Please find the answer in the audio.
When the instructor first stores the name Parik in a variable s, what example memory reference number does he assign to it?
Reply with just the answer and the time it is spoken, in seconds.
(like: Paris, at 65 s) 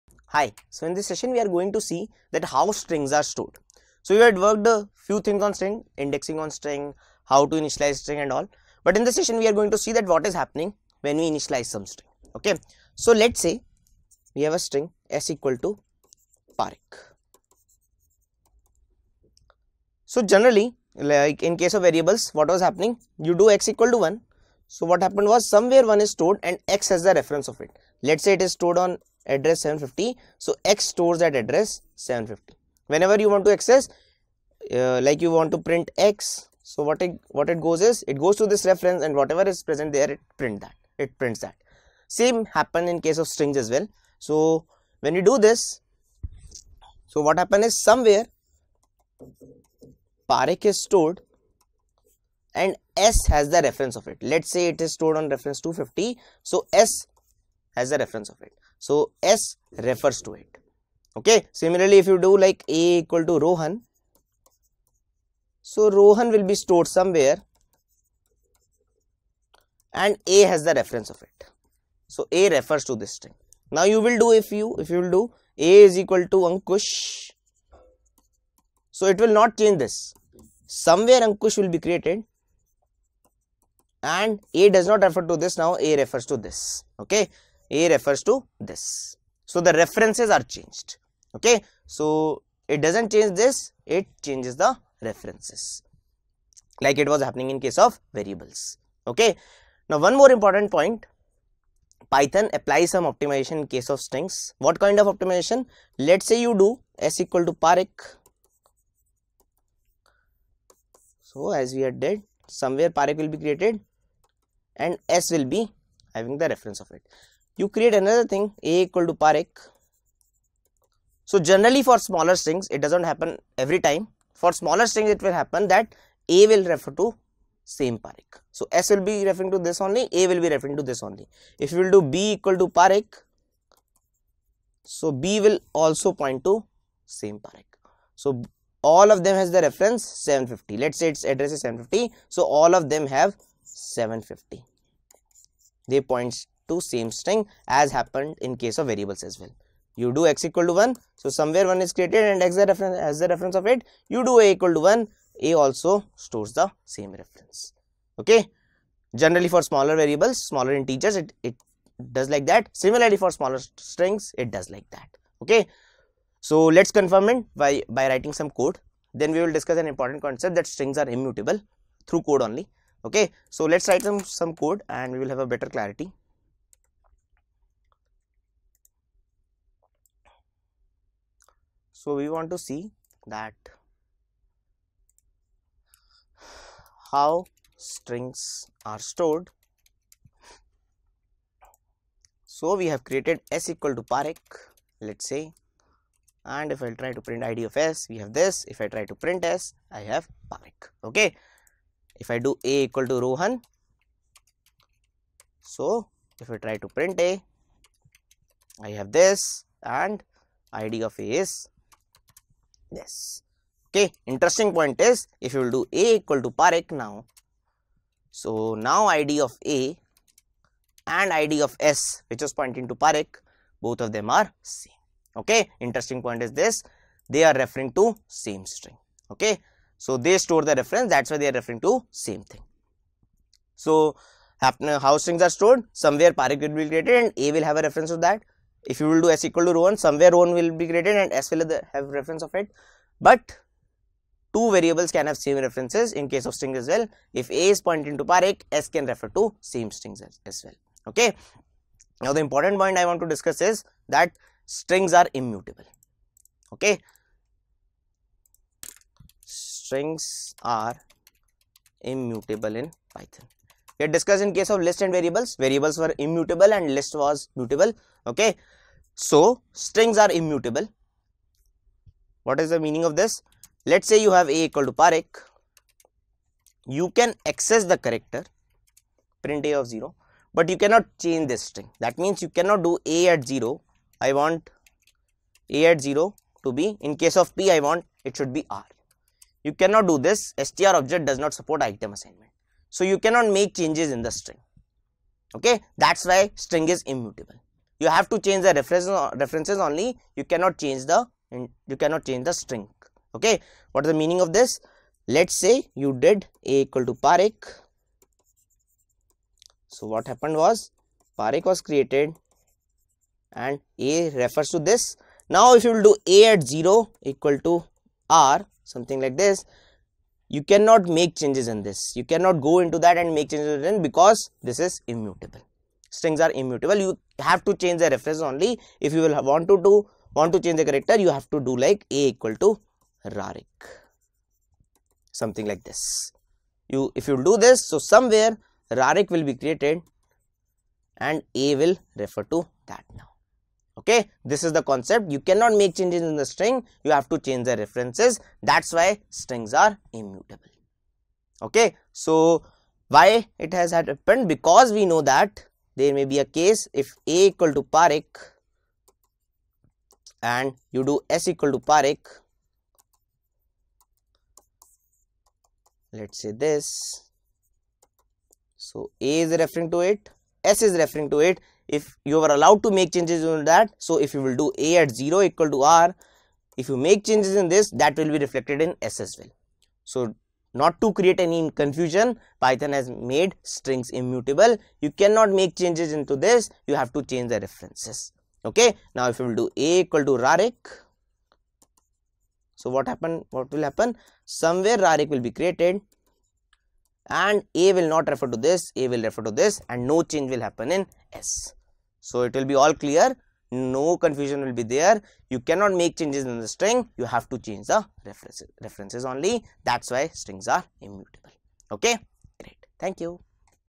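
250, at 55 s.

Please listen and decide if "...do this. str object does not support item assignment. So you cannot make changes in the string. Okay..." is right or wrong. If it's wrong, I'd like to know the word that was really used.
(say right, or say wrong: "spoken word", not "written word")
right.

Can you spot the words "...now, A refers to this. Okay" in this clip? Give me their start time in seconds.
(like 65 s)
85 s.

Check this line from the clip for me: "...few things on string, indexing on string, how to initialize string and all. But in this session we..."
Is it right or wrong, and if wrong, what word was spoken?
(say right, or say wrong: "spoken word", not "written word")
right.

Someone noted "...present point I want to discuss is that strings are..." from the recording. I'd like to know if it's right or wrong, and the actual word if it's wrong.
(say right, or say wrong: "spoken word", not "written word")
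wrong: "important", not "present".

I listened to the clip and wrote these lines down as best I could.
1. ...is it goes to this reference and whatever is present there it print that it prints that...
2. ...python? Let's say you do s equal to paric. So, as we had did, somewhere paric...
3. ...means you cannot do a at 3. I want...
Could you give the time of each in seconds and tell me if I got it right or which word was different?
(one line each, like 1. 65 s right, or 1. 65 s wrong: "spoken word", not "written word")
1. 37 s right
2. 105 s wrong: "optimization", not "python"
3. 282 s wrong: "0", not "3".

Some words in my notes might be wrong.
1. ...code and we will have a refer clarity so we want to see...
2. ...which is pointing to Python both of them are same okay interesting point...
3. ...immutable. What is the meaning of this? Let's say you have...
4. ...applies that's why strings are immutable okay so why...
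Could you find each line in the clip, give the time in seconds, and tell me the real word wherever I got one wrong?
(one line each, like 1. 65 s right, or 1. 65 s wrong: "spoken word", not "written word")
1. 174 s wrong: "better", not "refer"
2. 222 s wrong: "Parekh", not "Python"
3. 270 s right
4. 347 s wrong: "references", not "applies".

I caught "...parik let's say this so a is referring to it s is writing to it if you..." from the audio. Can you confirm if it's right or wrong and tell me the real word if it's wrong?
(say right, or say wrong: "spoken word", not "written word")
wrong: "referring", not "writing".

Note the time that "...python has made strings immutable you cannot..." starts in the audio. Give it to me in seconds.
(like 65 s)
382 s.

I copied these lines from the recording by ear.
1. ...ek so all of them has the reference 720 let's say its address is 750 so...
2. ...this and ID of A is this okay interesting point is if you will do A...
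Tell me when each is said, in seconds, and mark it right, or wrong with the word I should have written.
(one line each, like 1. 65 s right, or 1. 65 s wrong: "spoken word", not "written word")
1. 137 s wrong: "750", not "720"
2. 209 s right.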